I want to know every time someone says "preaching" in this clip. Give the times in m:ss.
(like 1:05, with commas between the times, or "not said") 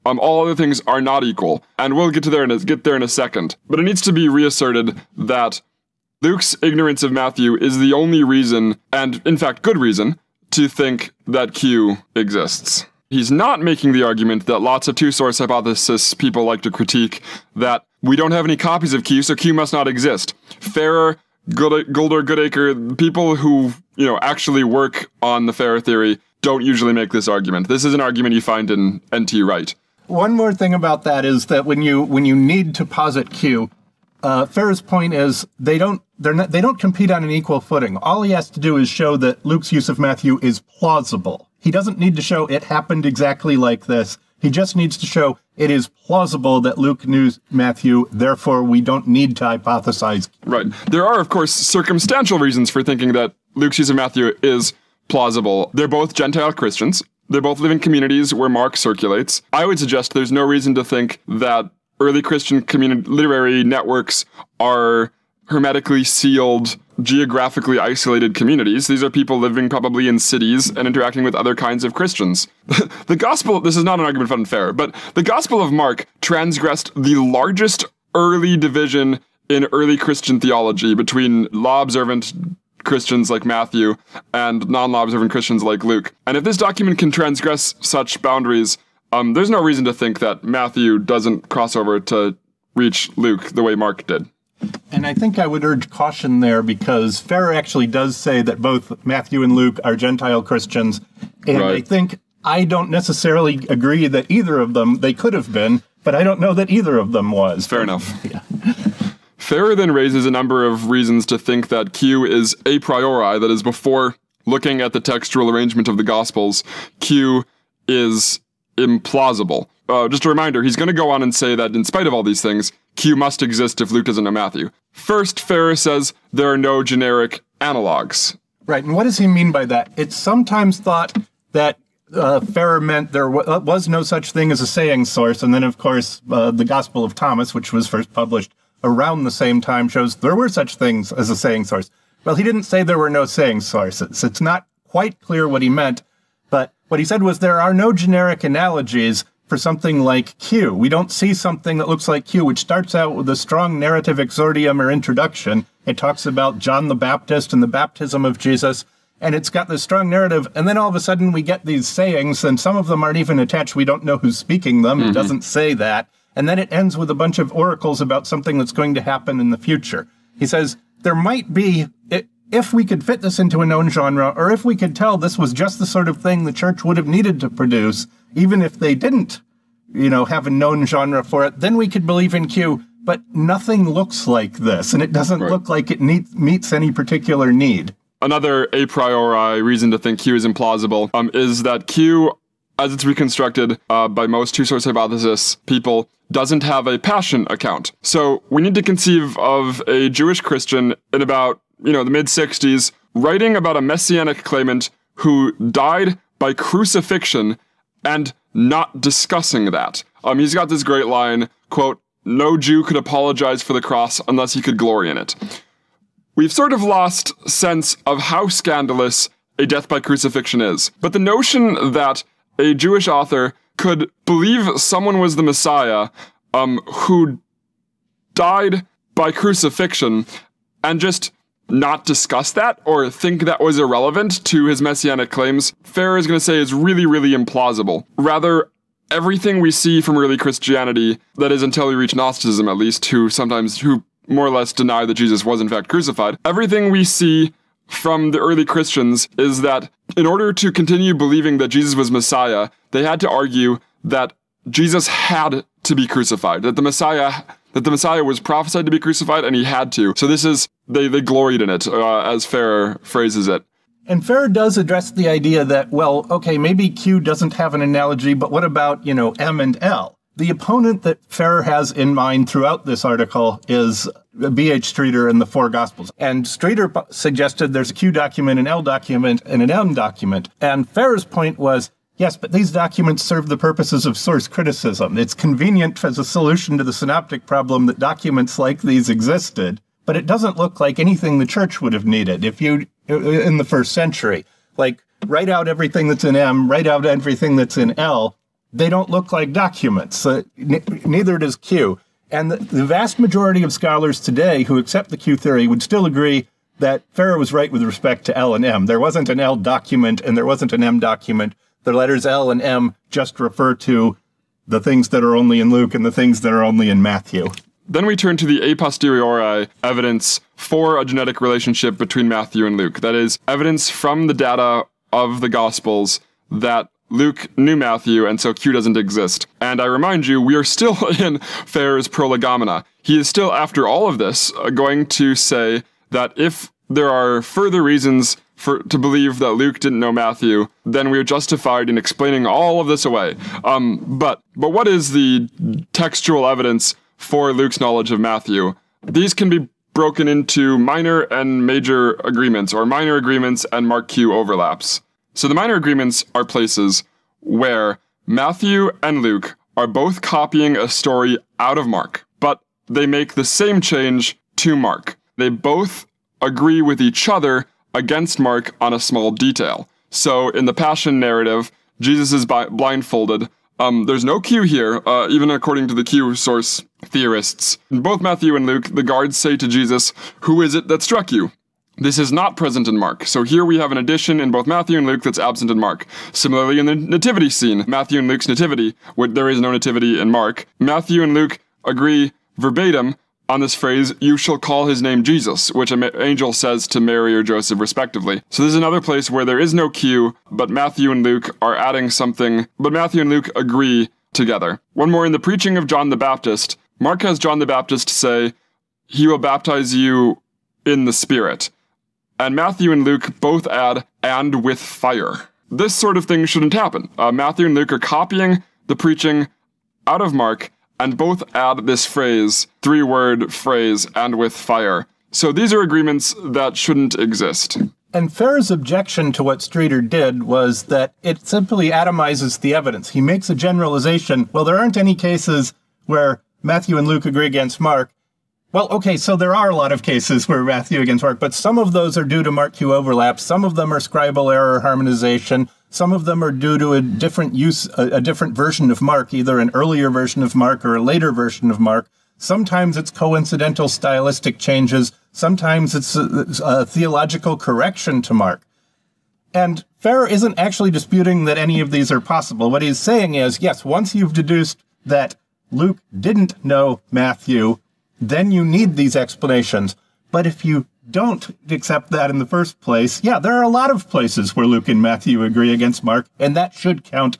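6:45, 6:58.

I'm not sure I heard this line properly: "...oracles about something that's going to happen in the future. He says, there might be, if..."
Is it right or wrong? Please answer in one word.
right.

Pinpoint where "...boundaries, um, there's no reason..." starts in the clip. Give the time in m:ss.
1:28.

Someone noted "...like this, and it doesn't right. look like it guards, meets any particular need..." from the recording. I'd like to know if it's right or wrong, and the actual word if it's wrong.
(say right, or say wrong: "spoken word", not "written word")
wrong: "needs", not "guards".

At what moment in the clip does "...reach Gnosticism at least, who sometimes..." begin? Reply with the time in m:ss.
4:01.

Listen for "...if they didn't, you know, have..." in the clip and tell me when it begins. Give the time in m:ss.
2:58.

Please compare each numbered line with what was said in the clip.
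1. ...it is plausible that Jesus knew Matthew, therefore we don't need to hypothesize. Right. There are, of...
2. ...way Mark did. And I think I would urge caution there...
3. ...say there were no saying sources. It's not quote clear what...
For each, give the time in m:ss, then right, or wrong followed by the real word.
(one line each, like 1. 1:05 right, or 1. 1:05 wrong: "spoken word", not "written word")
1. 0:45 wrong: "Luke", not "Jesus"
2. 1:33 right
3. 2:22 wrong: "quite", not "quote".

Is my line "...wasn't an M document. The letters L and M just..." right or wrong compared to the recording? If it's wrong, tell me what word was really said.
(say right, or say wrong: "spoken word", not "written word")
right.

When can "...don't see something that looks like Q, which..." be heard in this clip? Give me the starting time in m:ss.
2:30.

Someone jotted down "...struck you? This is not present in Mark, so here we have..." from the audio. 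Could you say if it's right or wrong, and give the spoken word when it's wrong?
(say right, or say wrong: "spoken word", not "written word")
right.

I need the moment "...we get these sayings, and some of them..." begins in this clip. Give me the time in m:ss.
2:41.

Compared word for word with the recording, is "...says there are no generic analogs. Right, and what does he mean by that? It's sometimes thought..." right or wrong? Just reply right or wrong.
right.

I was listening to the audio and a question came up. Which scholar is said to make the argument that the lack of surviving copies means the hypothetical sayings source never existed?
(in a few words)
NT Wright.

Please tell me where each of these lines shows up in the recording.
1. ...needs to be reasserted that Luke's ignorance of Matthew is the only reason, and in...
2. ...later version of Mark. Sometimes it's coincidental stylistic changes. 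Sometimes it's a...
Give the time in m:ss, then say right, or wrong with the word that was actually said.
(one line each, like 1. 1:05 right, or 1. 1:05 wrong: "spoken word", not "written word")
1. 0:03 right
2. 7:31 right.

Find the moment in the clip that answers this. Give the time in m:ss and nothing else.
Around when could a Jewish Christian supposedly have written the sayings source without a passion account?
3:22.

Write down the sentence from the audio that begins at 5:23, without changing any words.
That is, evidence from the data of the Gospels that Luke knew Matthew, and so Q doesn't exist.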